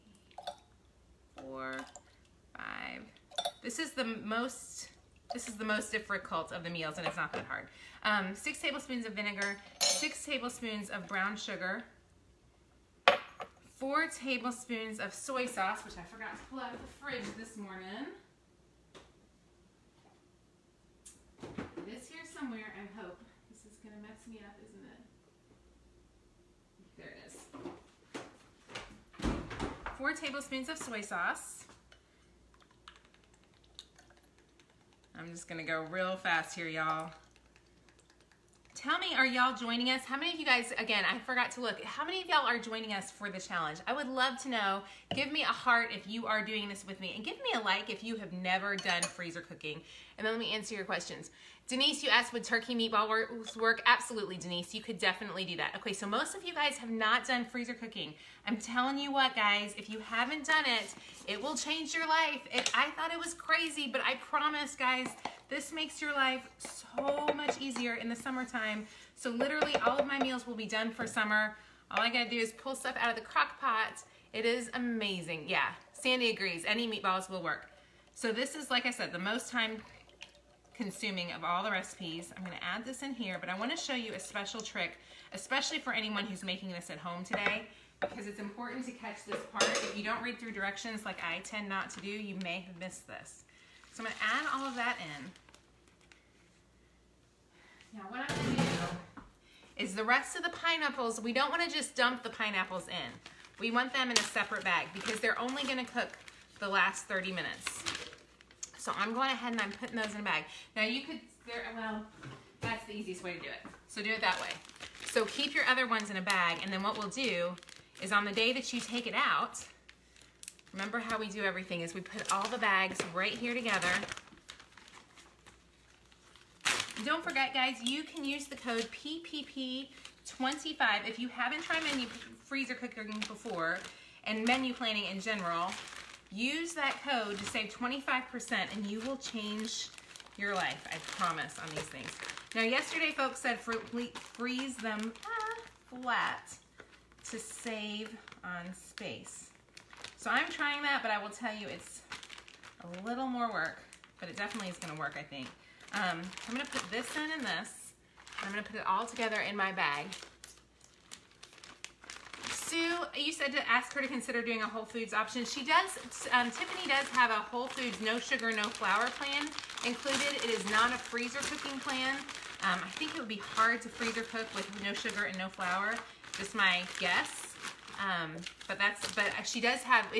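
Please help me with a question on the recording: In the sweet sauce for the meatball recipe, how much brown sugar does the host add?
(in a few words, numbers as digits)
6 tablespoons.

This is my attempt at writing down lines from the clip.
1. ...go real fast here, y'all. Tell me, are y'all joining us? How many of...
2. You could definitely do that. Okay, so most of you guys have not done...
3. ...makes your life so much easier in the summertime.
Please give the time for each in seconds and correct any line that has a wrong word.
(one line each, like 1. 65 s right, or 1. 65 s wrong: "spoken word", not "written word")
1. 35 s right
2. 54 s right
3. 65 s right.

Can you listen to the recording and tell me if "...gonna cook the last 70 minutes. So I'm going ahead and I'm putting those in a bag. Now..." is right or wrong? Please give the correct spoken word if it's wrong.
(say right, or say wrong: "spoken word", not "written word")
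wrong: "30", not "70".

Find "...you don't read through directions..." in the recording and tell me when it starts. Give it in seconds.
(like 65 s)
89 s.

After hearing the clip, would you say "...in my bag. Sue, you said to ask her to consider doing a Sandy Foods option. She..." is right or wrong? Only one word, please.
wrong.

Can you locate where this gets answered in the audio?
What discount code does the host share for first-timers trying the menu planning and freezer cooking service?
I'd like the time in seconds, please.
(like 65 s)
128 s.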